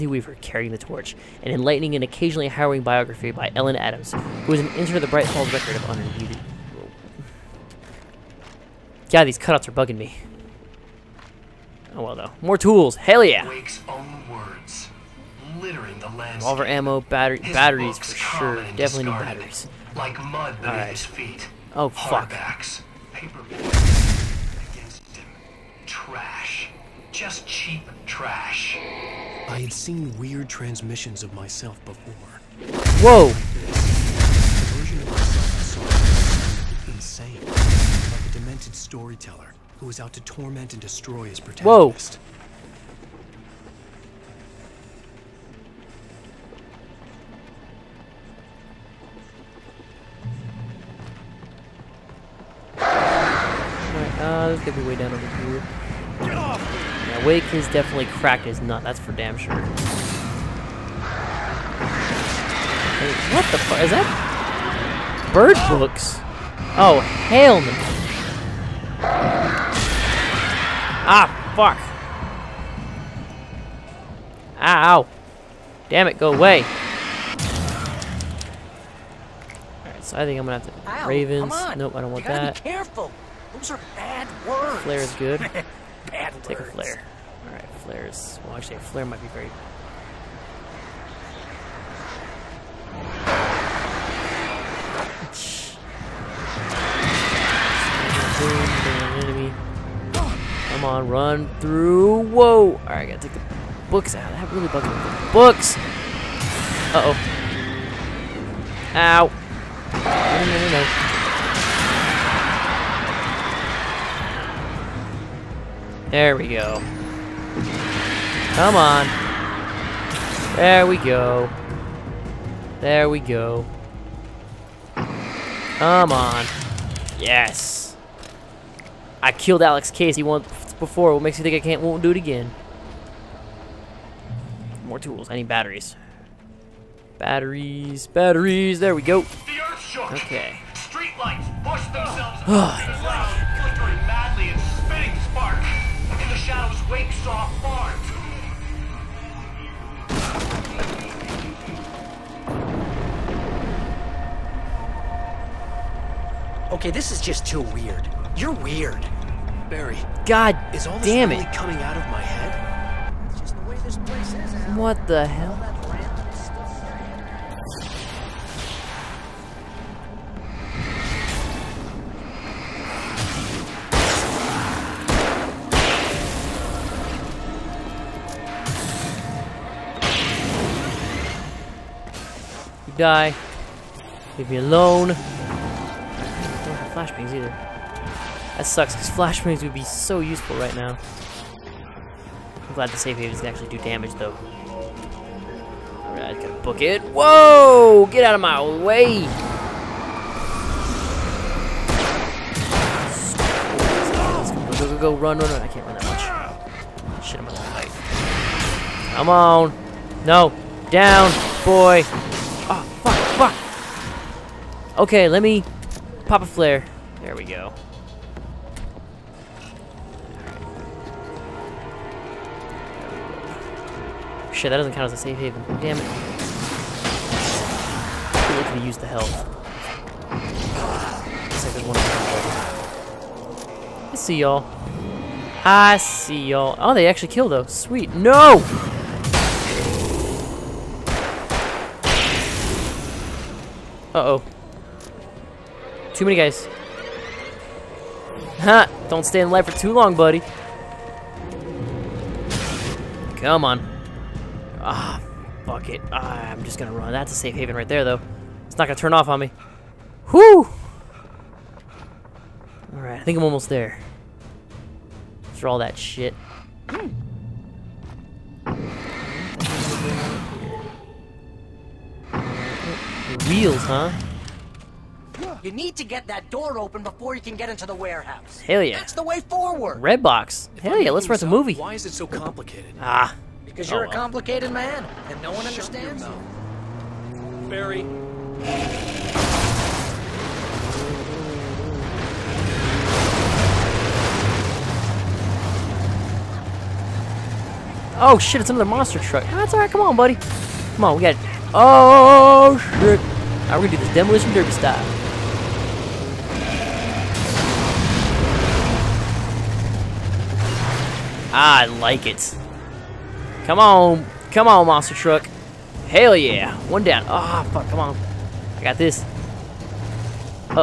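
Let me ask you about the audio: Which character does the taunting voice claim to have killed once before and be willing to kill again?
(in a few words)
Alex Casey.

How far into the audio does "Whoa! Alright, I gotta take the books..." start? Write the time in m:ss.
1:42.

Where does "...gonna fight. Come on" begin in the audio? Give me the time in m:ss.
3:27.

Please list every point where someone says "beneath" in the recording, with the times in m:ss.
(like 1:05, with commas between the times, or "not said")
0:20.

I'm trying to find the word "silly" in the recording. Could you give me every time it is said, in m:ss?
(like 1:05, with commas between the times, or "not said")
not said.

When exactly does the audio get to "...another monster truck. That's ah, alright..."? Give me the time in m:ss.
4:58.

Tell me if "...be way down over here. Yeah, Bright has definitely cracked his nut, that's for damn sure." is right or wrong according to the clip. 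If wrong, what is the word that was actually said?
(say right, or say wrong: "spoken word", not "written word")
wrong: "Wake", not "Bright".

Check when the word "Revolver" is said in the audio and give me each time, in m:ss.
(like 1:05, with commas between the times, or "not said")
0:16.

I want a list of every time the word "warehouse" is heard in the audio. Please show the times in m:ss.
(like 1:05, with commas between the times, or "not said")
4:37.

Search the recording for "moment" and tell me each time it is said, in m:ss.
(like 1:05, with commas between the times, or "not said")
not said.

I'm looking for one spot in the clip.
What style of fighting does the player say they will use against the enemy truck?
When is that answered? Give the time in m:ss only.
5:04.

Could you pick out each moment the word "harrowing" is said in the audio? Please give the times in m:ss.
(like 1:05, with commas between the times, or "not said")
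0:02.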